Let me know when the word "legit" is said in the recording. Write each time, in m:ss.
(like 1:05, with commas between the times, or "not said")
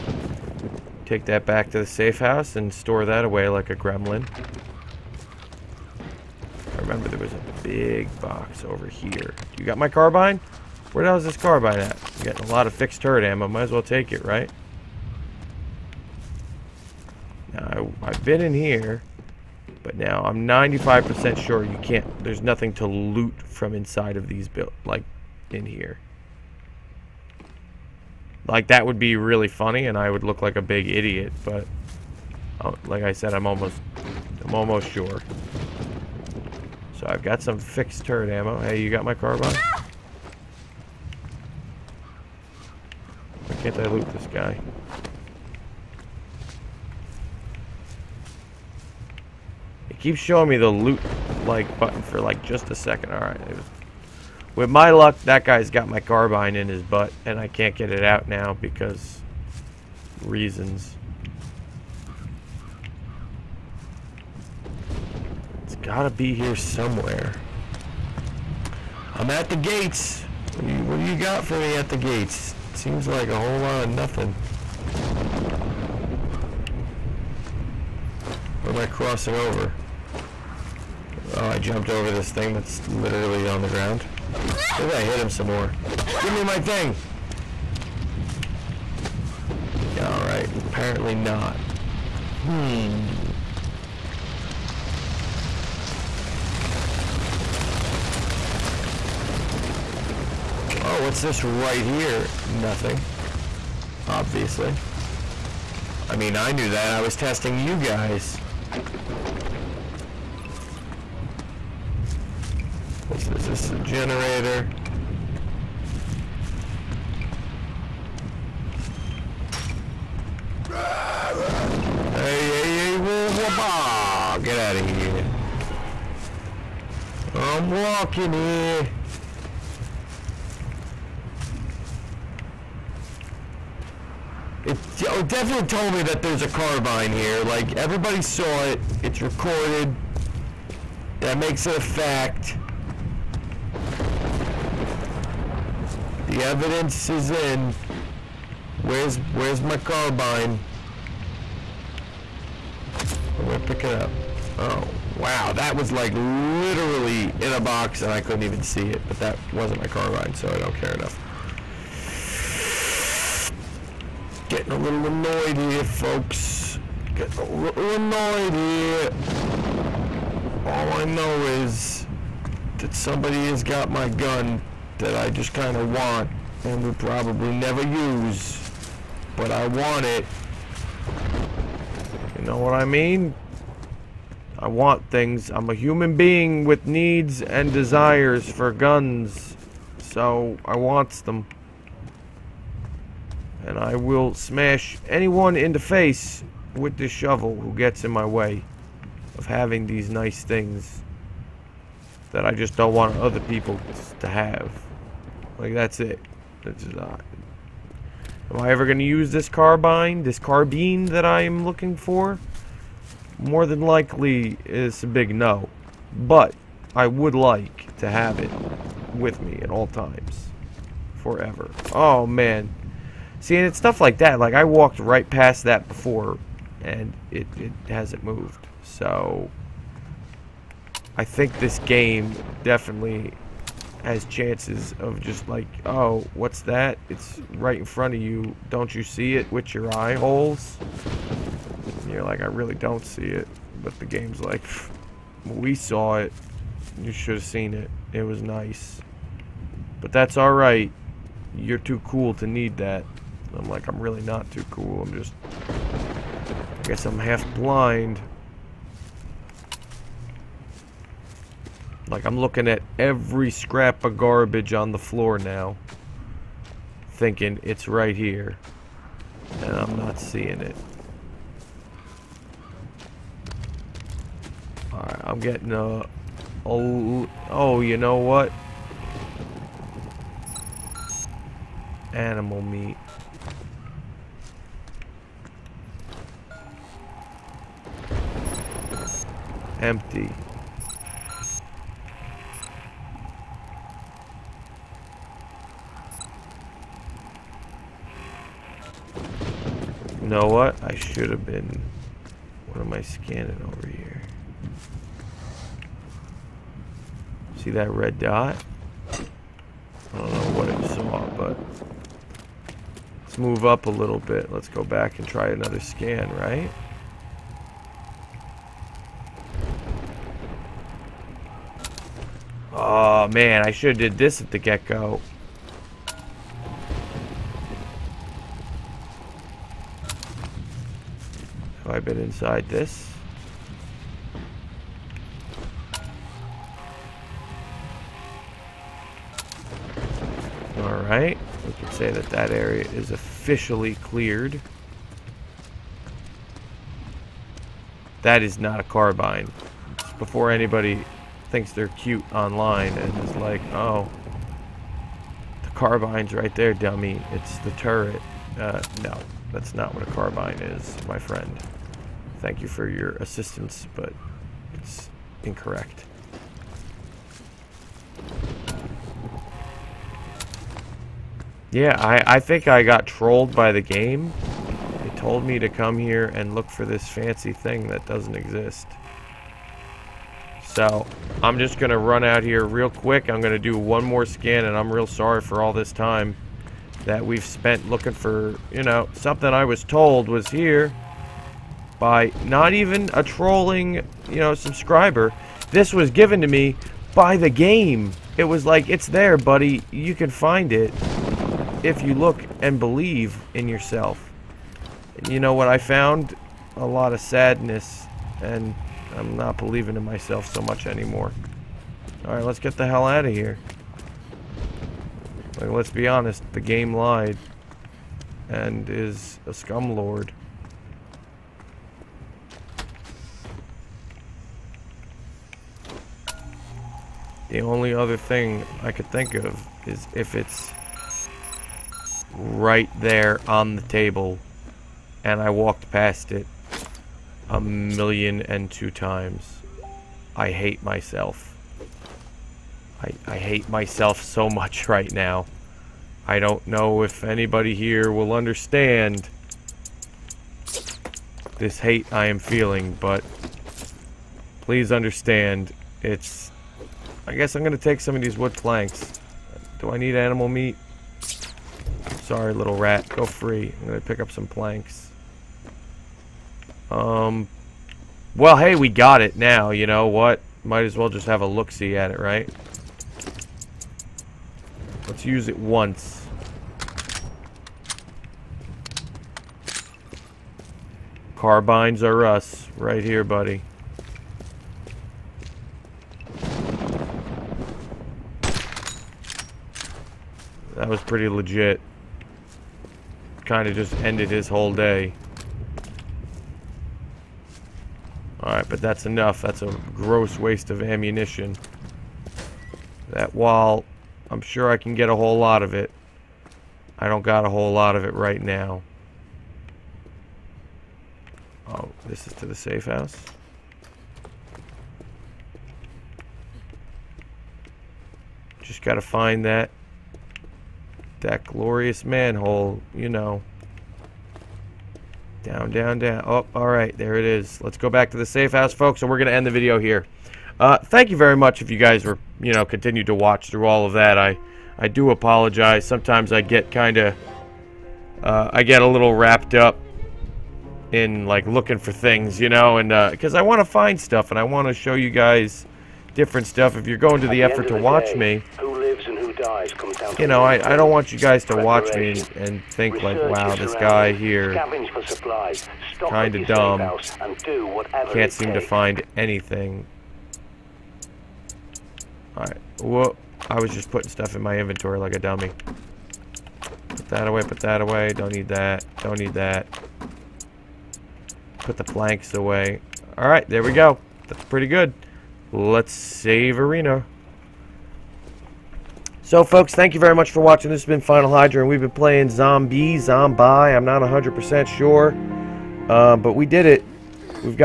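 8:11.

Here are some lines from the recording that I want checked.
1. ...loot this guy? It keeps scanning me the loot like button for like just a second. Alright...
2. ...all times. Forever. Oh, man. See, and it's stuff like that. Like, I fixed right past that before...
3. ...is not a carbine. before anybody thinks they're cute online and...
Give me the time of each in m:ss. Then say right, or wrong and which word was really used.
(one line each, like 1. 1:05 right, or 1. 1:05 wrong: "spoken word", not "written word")
1. 0:43 wrong: "showing", not "scanning"
2. 3:39 wrong: "walked", not "fixed"
3. 5:48 right.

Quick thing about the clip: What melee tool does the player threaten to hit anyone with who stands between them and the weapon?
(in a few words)
Shovel.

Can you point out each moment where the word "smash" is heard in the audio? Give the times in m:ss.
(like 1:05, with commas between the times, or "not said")
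3:14.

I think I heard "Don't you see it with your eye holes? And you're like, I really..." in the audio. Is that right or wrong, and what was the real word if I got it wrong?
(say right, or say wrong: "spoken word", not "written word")
right.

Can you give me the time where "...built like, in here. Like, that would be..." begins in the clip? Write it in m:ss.
0:24.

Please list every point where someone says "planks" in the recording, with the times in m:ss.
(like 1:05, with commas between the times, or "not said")
7:38, 7:44, 9:31.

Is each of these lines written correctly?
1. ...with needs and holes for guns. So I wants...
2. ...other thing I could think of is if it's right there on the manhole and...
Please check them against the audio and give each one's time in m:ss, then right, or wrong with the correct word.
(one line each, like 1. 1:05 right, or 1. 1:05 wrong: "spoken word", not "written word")
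1. 3:06 wrong: "desires", not "holes"
2. 7:07 wrong: "table", not "manhole".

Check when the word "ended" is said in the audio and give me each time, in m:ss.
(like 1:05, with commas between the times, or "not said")
8:14.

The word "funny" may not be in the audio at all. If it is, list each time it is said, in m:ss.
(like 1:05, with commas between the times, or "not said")
0:29.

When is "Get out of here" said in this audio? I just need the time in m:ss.
2:04.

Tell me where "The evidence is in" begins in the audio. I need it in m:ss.
2:26.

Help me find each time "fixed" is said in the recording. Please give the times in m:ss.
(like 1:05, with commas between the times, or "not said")
0:12, 0:37.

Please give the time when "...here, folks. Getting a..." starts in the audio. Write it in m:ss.
2:45.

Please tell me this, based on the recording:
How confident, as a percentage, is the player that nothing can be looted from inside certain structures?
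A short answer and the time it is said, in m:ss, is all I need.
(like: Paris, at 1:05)
95%, at 0:20.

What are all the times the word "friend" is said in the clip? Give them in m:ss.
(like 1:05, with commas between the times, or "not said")
6:01.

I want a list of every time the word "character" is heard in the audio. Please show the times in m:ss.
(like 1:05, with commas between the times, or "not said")
not said.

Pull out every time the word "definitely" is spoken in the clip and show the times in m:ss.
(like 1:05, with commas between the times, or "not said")
2:15, 3:52.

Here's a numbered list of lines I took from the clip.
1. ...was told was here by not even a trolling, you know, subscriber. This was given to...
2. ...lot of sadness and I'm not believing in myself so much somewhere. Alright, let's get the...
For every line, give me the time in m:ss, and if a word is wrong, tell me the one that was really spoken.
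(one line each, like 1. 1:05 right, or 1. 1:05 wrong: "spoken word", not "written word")
1. 6:29 right
2. 6:46 wrong: "anymore", not "somewhere".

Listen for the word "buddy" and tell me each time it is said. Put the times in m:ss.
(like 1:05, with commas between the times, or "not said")
6:39, 8:03.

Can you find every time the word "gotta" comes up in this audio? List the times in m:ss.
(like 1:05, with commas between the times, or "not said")
1:05, 8:38.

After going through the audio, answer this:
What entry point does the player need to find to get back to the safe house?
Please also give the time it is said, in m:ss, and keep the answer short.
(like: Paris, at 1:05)
Manhole, at 8:42.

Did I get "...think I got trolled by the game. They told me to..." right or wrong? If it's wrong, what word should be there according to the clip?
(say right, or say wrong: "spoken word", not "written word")
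right.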